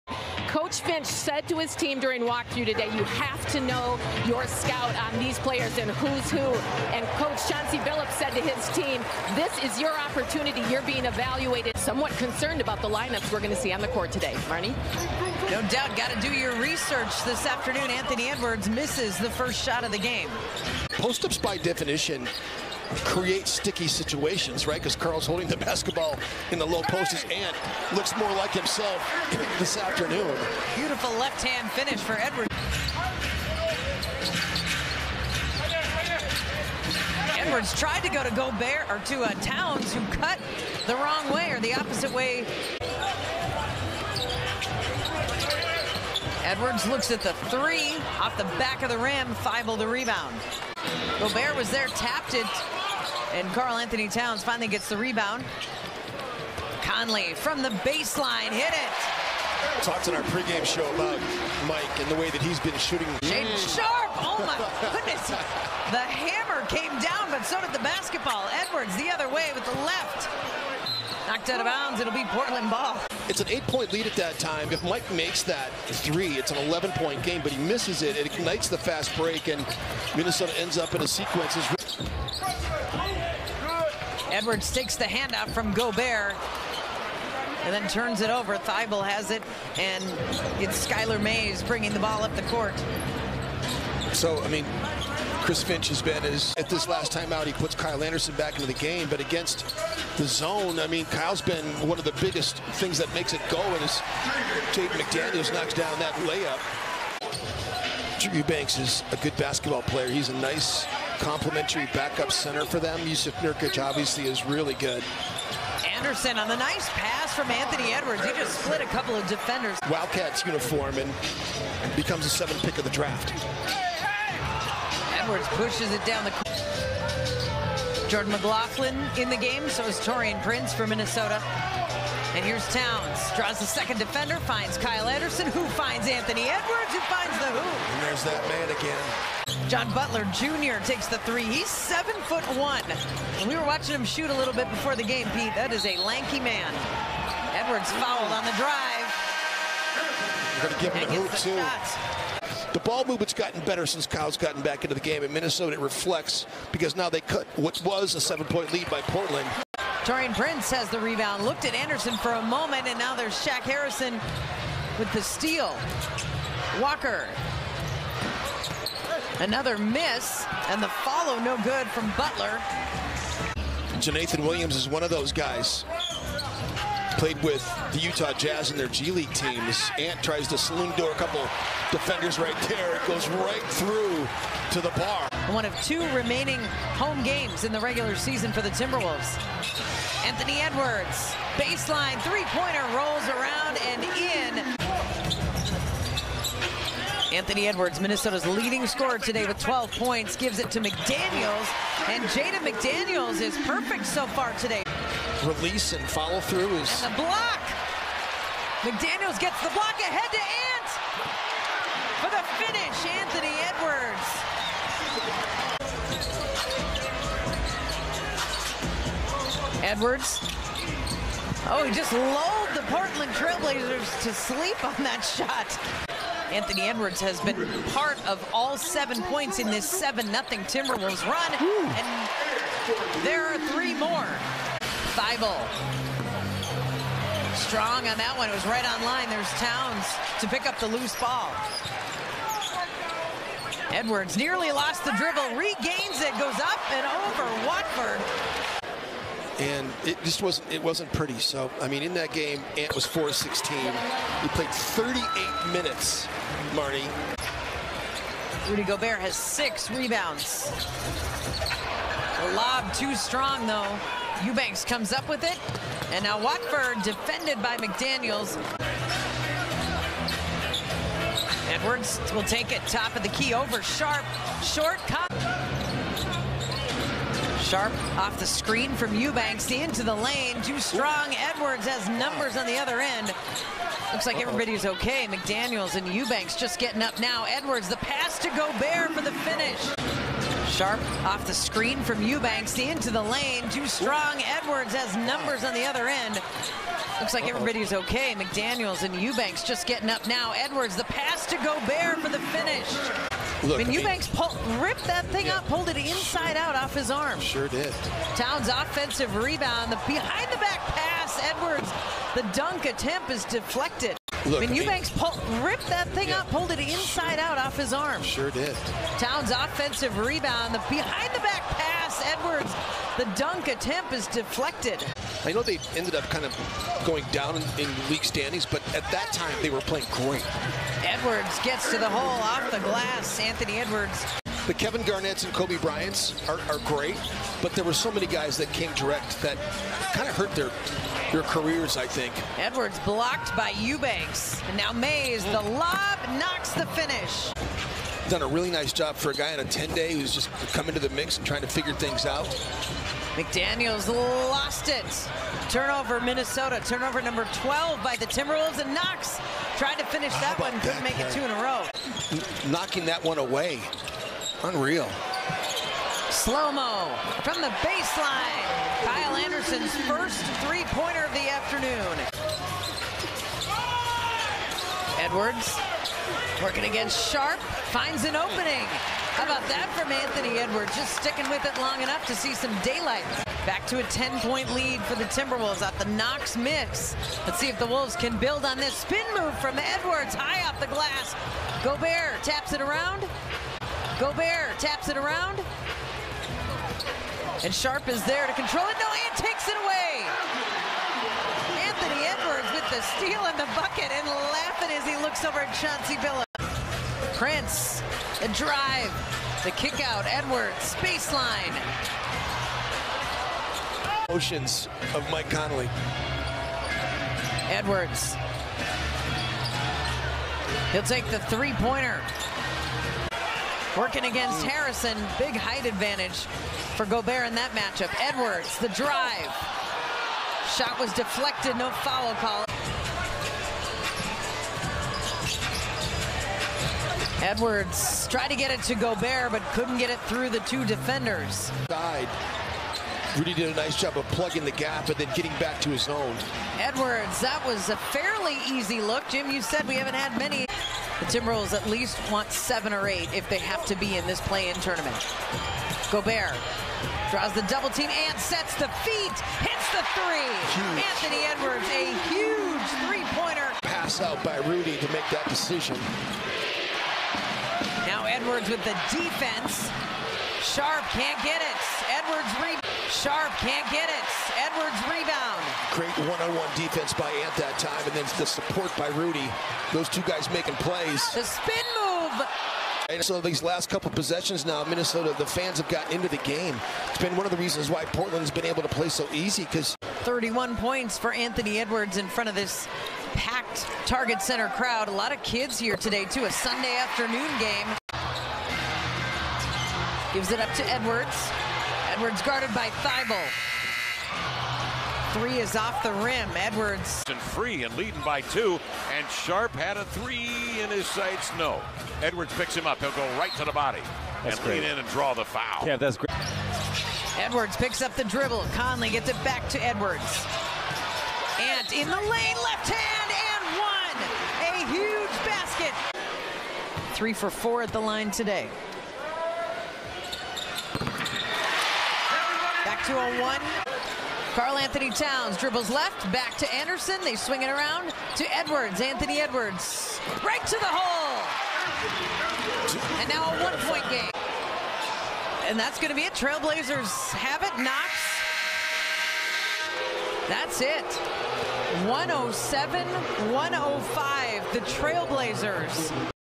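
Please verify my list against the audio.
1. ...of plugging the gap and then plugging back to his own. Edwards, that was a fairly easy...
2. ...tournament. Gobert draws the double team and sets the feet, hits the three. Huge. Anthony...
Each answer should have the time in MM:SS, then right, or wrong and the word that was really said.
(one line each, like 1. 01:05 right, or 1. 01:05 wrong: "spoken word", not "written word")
1. 07:24 wrong: "getting", not "plugging"
2. 07:34 right.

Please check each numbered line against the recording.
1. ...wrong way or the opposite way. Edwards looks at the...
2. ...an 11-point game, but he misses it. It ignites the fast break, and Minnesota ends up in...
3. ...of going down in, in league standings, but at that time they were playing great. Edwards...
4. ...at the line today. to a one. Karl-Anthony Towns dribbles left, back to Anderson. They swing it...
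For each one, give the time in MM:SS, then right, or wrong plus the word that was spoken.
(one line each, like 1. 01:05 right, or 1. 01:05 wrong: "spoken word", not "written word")
1. 00:40 right
2. 01:16 right
3. 05:26 right
4. 08:47 right.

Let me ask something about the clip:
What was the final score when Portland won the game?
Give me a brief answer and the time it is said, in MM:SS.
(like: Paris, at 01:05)
107-105, at 09:12.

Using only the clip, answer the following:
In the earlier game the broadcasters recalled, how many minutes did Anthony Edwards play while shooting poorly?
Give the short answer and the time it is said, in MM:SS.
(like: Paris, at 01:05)
38, at 04:14.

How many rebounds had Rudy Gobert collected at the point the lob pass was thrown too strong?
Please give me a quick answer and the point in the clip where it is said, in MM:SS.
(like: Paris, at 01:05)
6, at 04:19.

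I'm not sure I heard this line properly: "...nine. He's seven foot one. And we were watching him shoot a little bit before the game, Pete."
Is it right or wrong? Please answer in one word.
wrong.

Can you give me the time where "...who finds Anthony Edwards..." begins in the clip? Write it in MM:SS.
02:15.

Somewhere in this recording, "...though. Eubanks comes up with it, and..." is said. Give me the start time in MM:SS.
04:23.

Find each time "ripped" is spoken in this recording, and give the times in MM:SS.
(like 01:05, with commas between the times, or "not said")
05:04, 05:15.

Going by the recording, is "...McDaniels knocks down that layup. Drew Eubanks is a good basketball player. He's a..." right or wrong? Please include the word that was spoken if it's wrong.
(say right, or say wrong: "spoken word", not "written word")
right.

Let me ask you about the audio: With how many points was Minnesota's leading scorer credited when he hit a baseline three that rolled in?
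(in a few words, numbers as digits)
12.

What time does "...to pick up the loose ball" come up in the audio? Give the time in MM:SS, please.
04:00.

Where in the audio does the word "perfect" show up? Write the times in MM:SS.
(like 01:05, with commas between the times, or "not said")
03:23.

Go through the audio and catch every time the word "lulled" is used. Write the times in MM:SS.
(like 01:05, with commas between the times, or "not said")
03:42.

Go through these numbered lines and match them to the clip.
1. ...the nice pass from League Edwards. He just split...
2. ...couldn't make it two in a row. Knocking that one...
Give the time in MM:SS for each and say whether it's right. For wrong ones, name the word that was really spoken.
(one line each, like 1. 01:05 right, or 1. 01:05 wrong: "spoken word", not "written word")
1. 01:56 wrong: "Anthony", not "League"
2. 06:00 right.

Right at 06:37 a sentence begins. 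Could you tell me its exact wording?
And Sharpe is there to control it.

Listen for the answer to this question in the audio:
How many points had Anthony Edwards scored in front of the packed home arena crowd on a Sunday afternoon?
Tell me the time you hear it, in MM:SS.
08:10.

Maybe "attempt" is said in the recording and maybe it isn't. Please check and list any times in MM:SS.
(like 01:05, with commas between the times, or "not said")
05:12, 05:23.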